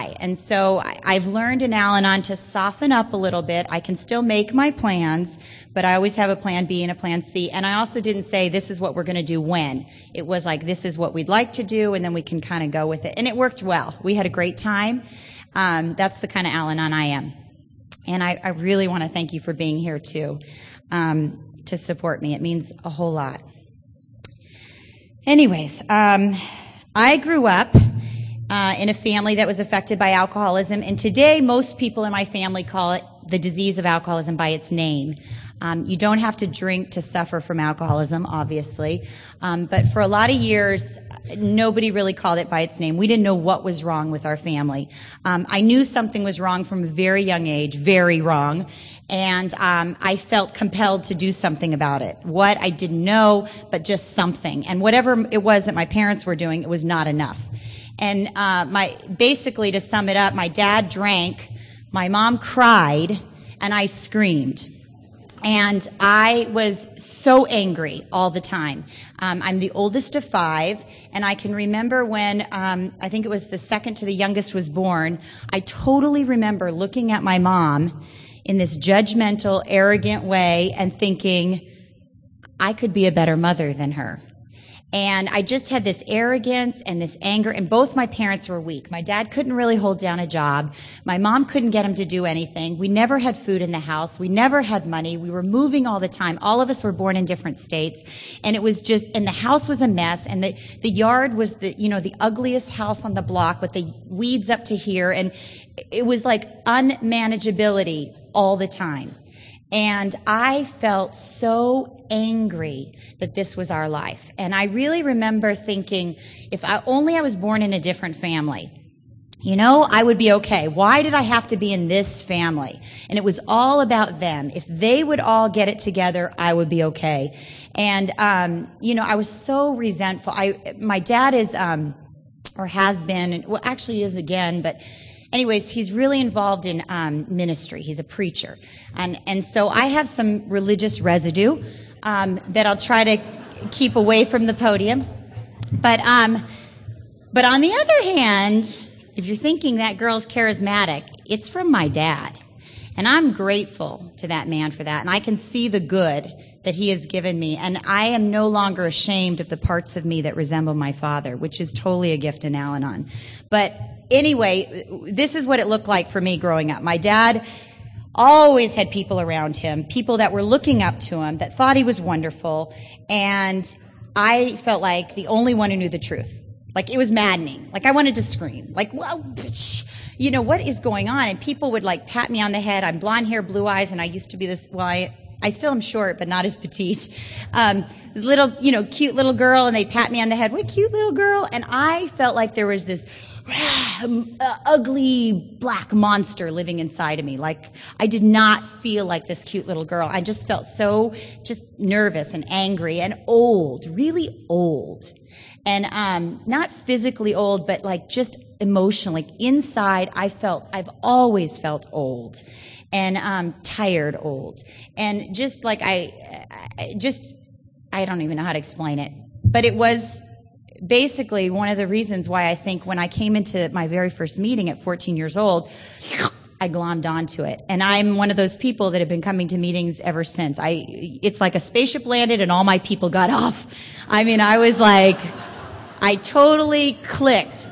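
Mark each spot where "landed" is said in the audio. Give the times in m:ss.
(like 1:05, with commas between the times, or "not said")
3:52.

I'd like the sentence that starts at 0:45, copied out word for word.
Um, I knew something was wrong from a very young age, very wrong.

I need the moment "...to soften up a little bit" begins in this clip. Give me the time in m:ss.
0:02.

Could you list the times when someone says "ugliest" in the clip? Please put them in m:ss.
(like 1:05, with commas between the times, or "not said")
1:42.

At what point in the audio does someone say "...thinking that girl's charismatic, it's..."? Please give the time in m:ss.
2:29.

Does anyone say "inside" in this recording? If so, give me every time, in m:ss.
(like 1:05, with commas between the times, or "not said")
3:16, 3:29.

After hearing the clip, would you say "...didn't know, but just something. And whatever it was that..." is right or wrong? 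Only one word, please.
right.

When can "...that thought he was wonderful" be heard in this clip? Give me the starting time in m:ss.
2:51.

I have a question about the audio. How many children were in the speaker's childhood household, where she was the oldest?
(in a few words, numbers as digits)
5.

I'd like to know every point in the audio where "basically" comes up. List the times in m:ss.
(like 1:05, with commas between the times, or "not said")
0:59, 3:40.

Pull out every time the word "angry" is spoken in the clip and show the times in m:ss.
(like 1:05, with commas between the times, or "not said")
1:07, 1:52, 3:22.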